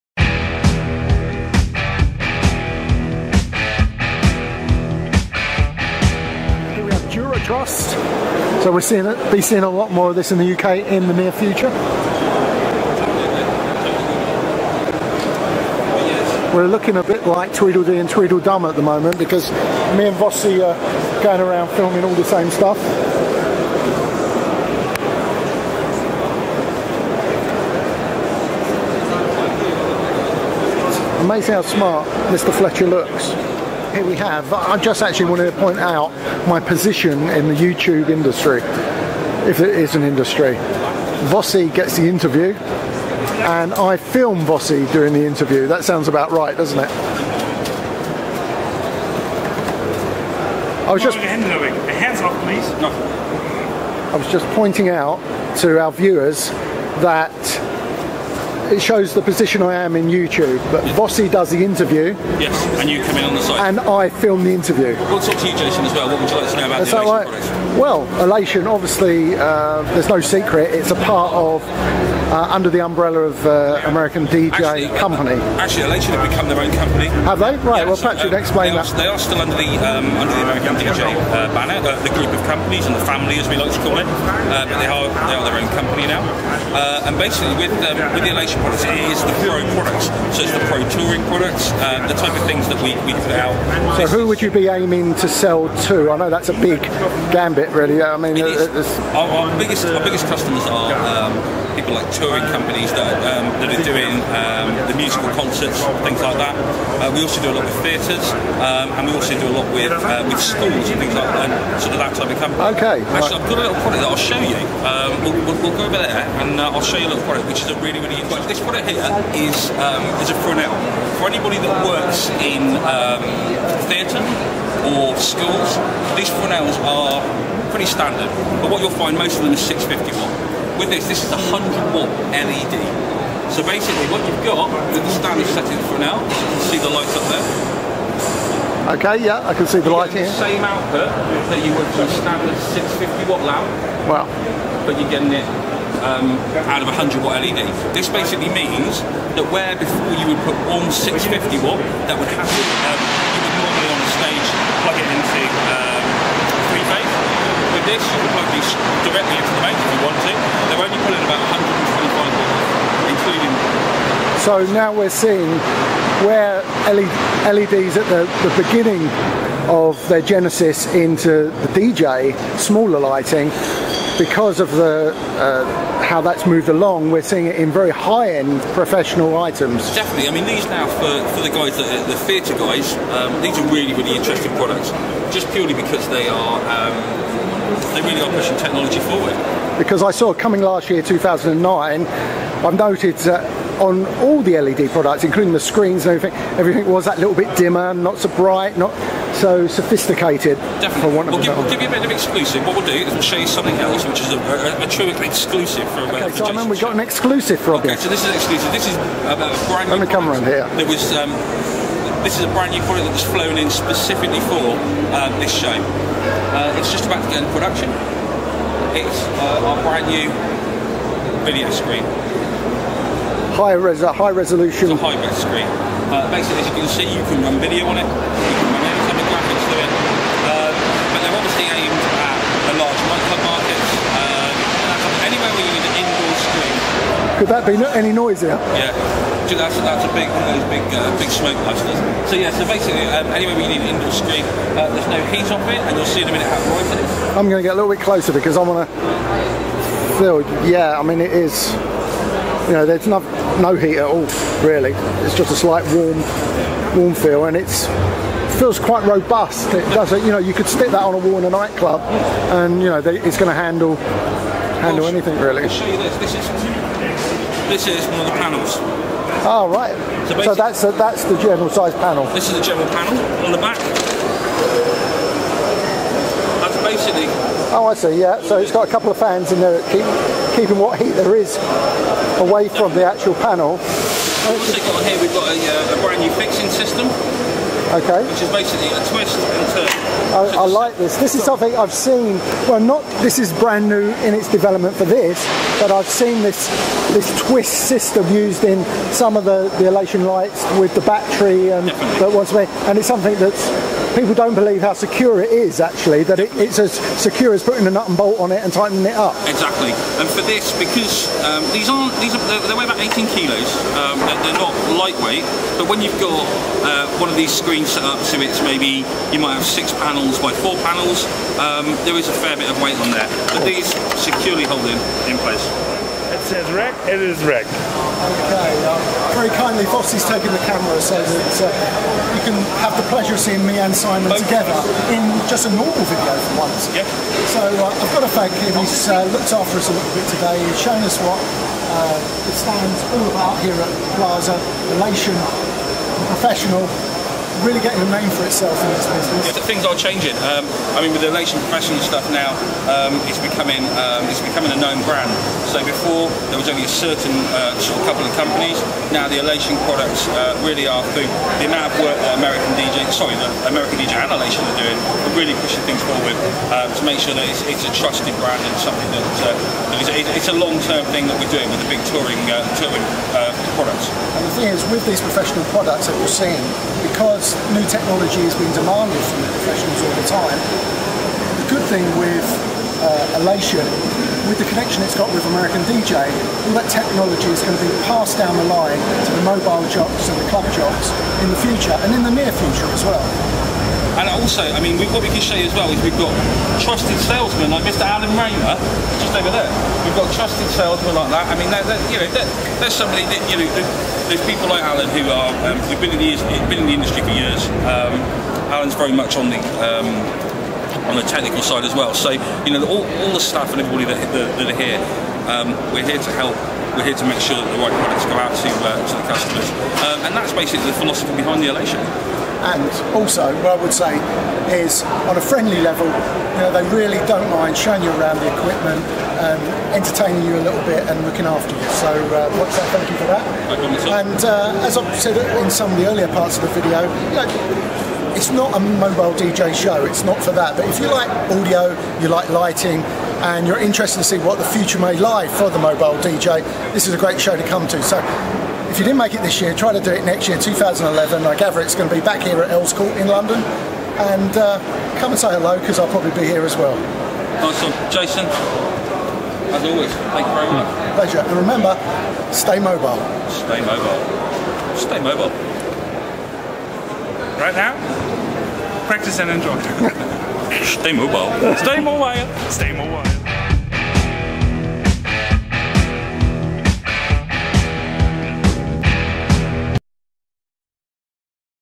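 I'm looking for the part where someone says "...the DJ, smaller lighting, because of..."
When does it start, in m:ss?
2:51.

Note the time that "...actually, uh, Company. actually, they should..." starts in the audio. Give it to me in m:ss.
1:14.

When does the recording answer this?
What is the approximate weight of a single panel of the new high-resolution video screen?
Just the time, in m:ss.
5:13.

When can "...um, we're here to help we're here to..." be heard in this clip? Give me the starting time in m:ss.
6:55.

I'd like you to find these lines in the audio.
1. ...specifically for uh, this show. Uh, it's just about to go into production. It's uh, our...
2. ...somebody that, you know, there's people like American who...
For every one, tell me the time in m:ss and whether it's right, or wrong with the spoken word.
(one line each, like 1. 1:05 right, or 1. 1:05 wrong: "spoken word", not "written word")
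1. 3:33 right
2. 6:42 wrong: "Alan", not "American".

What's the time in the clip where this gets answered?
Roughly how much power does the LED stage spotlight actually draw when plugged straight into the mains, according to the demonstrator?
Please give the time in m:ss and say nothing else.
2:41.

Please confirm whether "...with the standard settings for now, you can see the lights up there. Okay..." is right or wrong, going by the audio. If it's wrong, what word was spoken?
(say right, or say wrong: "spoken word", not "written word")
right.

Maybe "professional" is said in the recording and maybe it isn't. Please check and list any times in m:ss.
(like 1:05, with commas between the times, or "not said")
2:58, 5:46, 5:51, 6:15, 6:19.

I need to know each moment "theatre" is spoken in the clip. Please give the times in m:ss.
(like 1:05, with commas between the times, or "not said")
1:47, 2:03, 3:02.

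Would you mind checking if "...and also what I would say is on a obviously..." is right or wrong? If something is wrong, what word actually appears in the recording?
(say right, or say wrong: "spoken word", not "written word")
wrong: "friendly", not "obviously".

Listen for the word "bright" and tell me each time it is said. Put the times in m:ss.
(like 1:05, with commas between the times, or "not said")
3:18, 4:06.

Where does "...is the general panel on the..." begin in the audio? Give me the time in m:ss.
4:32.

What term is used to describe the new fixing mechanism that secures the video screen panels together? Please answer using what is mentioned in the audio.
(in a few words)
Twist and turn.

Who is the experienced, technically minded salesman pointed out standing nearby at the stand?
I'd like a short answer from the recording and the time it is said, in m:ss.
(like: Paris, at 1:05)
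Alan Raymer, at 6:38.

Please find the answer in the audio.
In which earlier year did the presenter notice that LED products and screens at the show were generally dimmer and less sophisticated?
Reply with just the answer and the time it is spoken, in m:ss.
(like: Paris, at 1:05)
2009, at 3:11.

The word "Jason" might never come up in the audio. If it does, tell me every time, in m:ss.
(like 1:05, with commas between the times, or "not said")
1:05, 7:38.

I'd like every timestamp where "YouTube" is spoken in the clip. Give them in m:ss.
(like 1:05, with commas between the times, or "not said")
0:37, 1:00.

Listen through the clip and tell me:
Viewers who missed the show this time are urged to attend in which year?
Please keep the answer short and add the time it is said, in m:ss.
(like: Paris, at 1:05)
2011, at 7:30.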